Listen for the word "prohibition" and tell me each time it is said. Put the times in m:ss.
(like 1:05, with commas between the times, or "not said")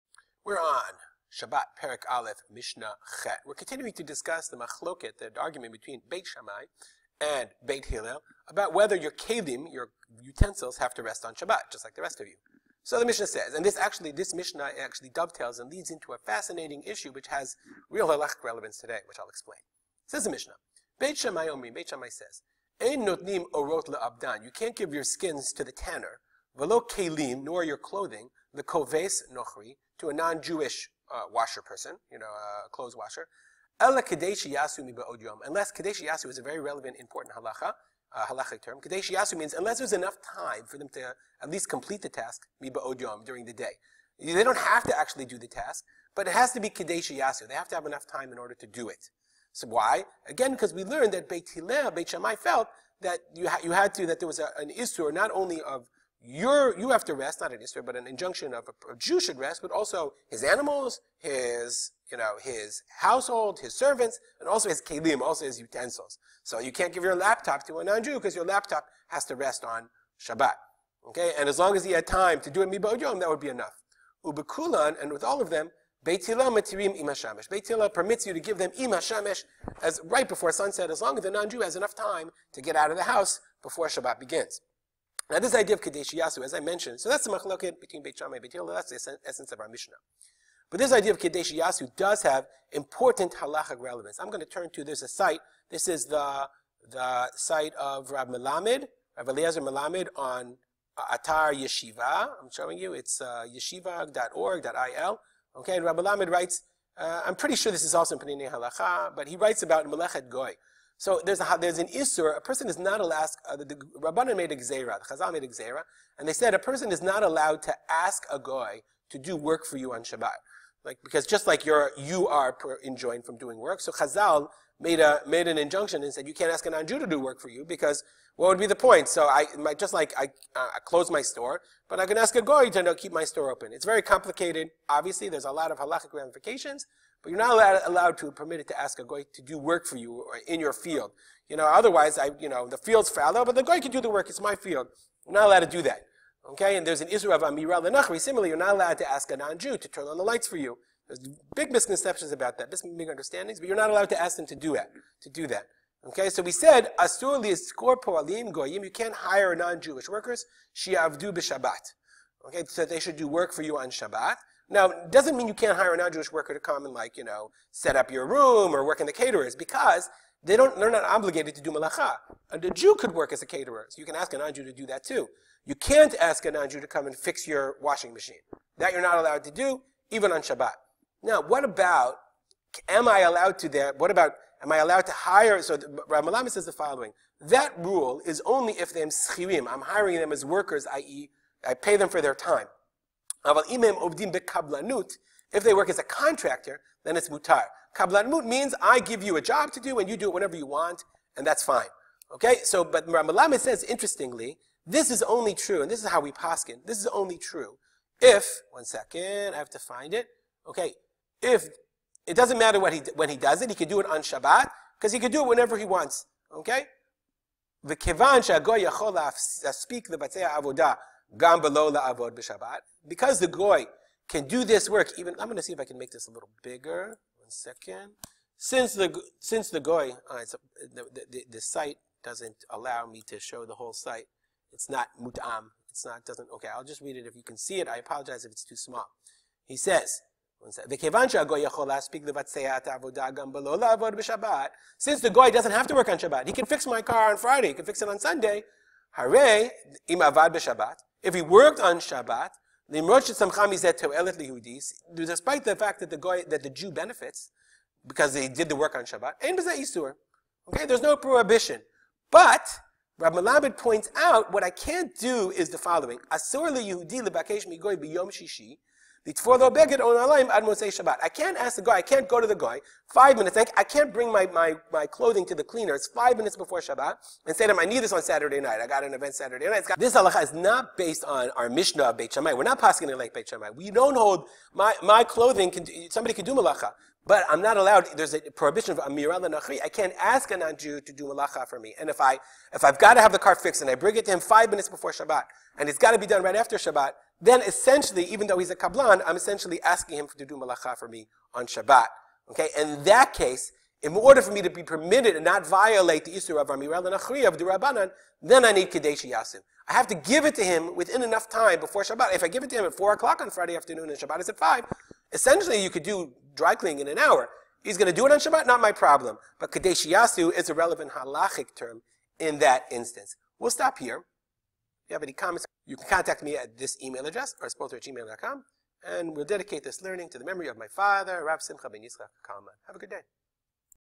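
4:21, 4:48.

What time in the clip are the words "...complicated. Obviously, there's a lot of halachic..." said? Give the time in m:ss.
2:14.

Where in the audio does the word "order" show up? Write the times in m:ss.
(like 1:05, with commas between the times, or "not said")
0:48, 5:04.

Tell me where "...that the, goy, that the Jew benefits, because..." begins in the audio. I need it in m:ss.
4:15.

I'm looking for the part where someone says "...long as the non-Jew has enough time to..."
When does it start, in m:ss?
1:21.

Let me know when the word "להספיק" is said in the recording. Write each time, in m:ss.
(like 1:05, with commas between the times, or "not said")
3:39.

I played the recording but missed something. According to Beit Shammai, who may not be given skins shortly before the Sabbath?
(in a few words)
The tanner.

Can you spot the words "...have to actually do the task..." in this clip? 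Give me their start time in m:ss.
0:44.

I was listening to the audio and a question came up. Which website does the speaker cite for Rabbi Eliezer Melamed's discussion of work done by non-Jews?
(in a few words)
yeshiva.org.il.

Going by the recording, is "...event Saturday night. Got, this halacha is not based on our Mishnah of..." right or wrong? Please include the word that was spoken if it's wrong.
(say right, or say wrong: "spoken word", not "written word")
right.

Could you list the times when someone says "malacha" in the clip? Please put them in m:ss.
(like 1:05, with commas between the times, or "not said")
2:51, 4:46, 4:51, 5:00.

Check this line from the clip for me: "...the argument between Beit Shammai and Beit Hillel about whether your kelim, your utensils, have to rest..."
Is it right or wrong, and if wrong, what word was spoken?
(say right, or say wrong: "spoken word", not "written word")
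right.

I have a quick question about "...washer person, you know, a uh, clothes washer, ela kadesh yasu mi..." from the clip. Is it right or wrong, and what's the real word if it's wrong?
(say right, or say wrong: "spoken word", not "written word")
right.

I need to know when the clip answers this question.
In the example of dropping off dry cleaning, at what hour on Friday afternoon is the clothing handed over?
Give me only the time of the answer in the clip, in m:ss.
5:12.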